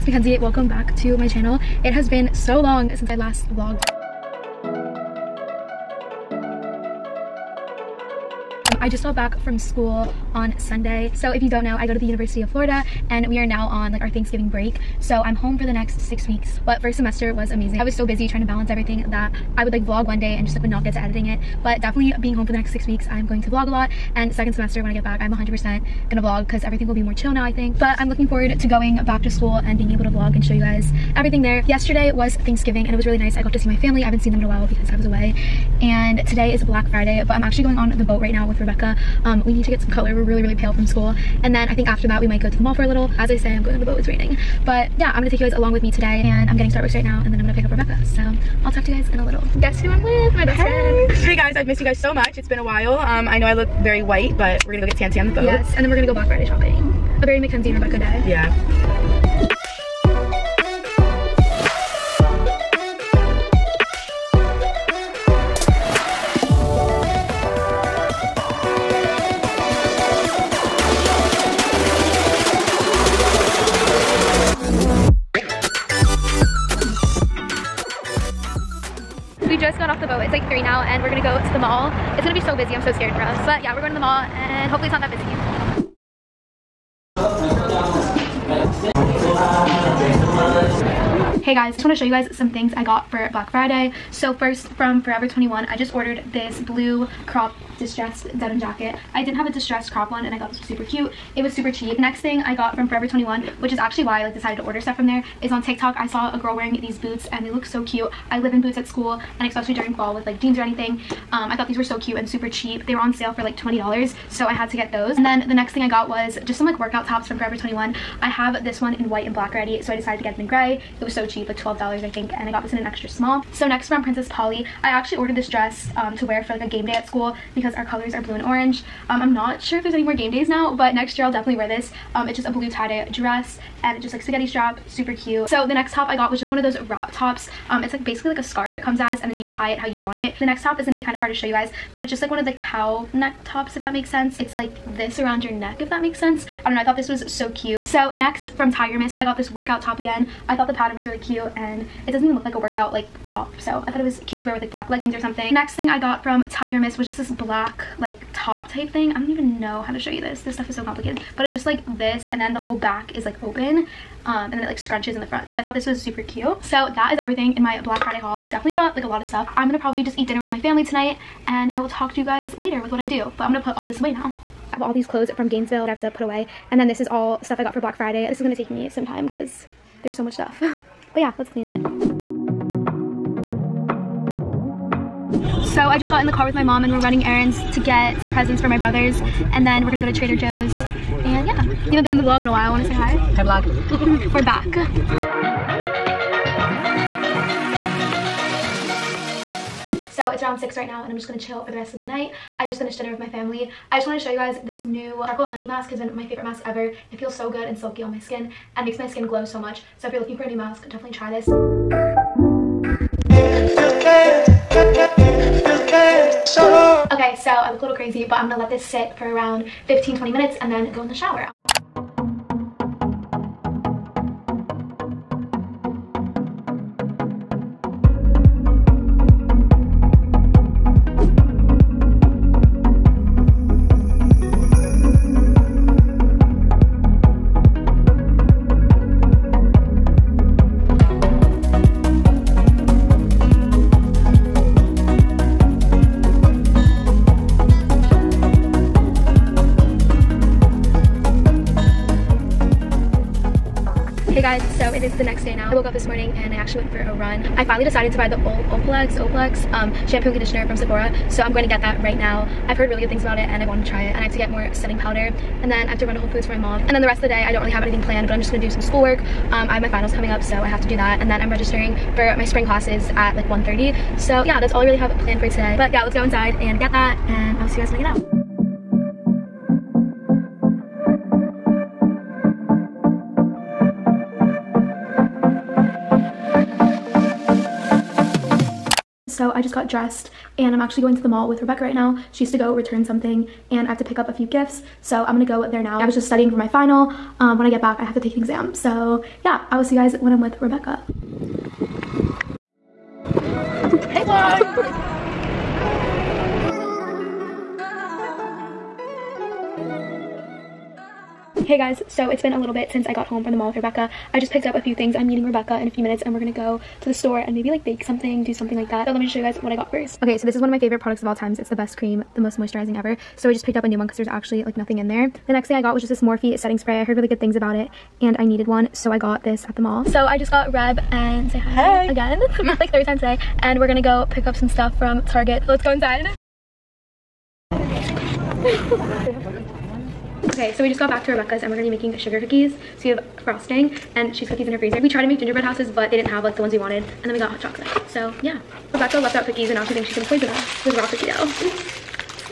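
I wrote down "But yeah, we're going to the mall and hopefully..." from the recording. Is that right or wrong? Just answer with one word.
right.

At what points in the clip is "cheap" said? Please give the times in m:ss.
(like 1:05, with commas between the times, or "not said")
1:41, 1:52, 2:01.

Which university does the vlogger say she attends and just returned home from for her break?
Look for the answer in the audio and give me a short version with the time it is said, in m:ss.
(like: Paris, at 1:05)
University of Florida, at 0:12.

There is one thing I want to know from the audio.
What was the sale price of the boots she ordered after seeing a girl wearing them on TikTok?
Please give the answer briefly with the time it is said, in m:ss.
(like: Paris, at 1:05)
$20, at 1:53.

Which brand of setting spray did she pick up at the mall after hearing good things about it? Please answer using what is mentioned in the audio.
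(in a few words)
Morphe.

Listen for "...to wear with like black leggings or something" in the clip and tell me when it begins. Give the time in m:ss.
2:34.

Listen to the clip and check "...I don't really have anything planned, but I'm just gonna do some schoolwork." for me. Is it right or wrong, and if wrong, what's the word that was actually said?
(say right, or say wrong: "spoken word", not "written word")
right.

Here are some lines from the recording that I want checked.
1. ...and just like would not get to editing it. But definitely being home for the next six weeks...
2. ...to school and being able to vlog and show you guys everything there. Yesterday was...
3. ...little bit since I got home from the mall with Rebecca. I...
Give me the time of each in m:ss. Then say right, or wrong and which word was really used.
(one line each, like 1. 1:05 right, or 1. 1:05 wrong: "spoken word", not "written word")
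1. 0:20 right
2. 0:29 right
3. 5:12 right.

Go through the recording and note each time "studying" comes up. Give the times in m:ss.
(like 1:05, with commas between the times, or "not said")
4:56.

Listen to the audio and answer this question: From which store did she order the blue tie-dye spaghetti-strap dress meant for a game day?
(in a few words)
Princess Polly.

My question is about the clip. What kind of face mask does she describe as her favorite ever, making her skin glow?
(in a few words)
charcoal honey mask.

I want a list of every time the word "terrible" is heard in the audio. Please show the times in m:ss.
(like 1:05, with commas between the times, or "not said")
not said.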